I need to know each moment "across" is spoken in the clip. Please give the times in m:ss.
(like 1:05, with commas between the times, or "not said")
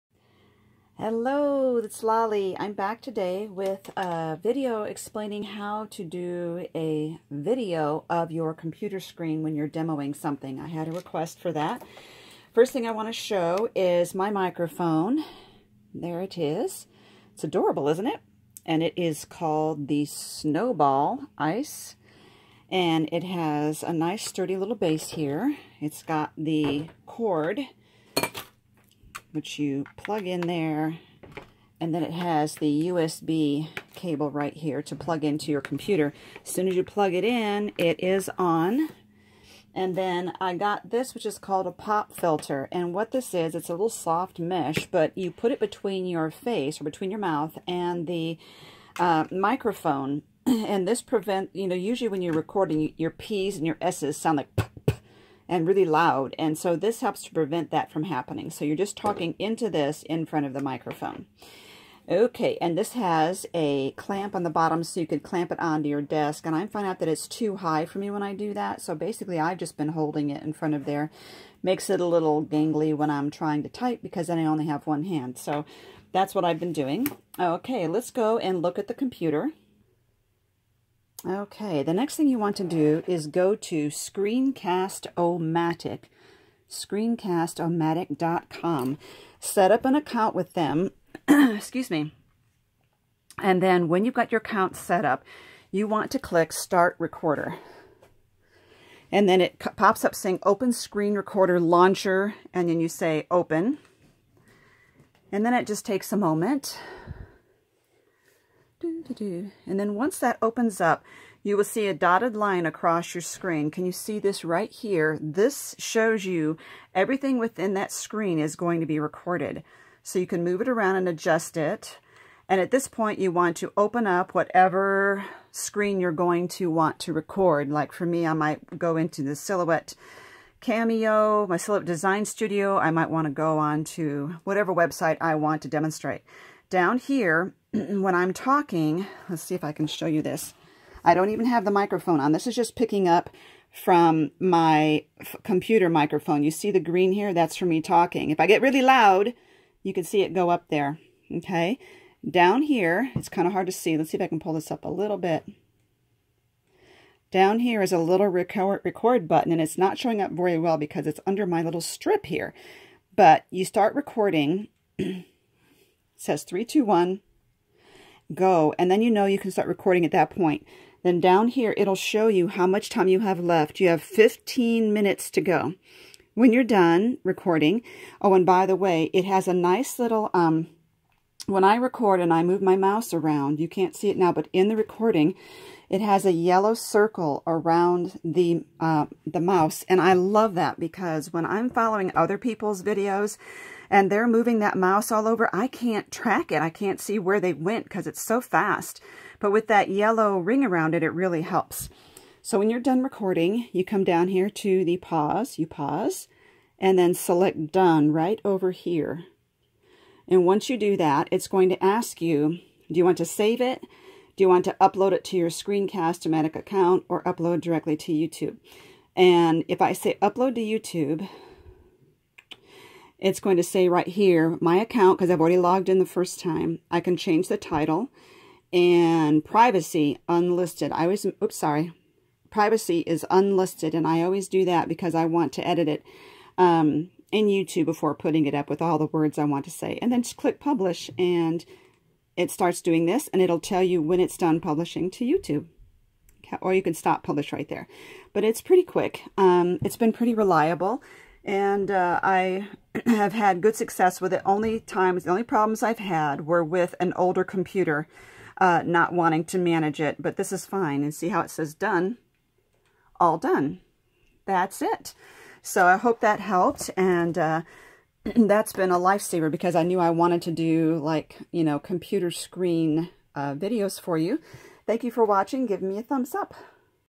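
1:52.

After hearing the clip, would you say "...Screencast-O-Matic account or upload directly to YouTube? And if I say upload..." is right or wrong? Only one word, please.
right.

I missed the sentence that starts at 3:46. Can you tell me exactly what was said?
I can change the title and privacy unlisted.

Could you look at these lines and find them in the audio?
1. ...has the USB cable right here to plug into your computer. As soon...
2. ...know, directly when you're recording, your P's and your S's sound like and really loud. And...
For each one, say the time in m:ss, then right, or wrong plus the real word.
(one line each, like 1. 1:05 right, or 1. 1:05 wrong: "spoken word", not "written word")
1. 0:32 right
2. 0:51 wrong: "usually", not "directly".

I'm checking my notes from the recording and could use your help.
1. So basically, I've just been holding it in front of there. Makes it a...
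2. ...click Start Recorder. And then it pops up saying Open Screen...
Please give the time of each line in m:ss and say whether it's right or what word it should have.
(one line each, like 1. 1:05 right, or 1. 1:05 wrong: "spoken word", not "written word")
1. 1:08 right
2. 1:36 right.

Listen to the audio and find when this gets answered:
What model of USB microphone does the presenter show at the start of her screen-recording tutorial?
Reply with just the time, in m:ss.
0:20.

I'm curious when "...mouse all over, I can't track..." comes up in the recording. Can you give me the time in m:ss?
3:14.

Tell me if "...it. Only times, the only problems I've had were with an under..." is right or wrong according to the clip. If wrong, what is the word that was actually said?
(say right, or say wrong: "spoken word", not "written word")
wrong: "older", not "under".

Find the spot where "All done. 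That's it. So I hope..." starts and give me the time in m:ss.
4:23.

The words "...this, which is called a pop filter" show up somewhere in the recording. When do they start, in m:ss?
0:40.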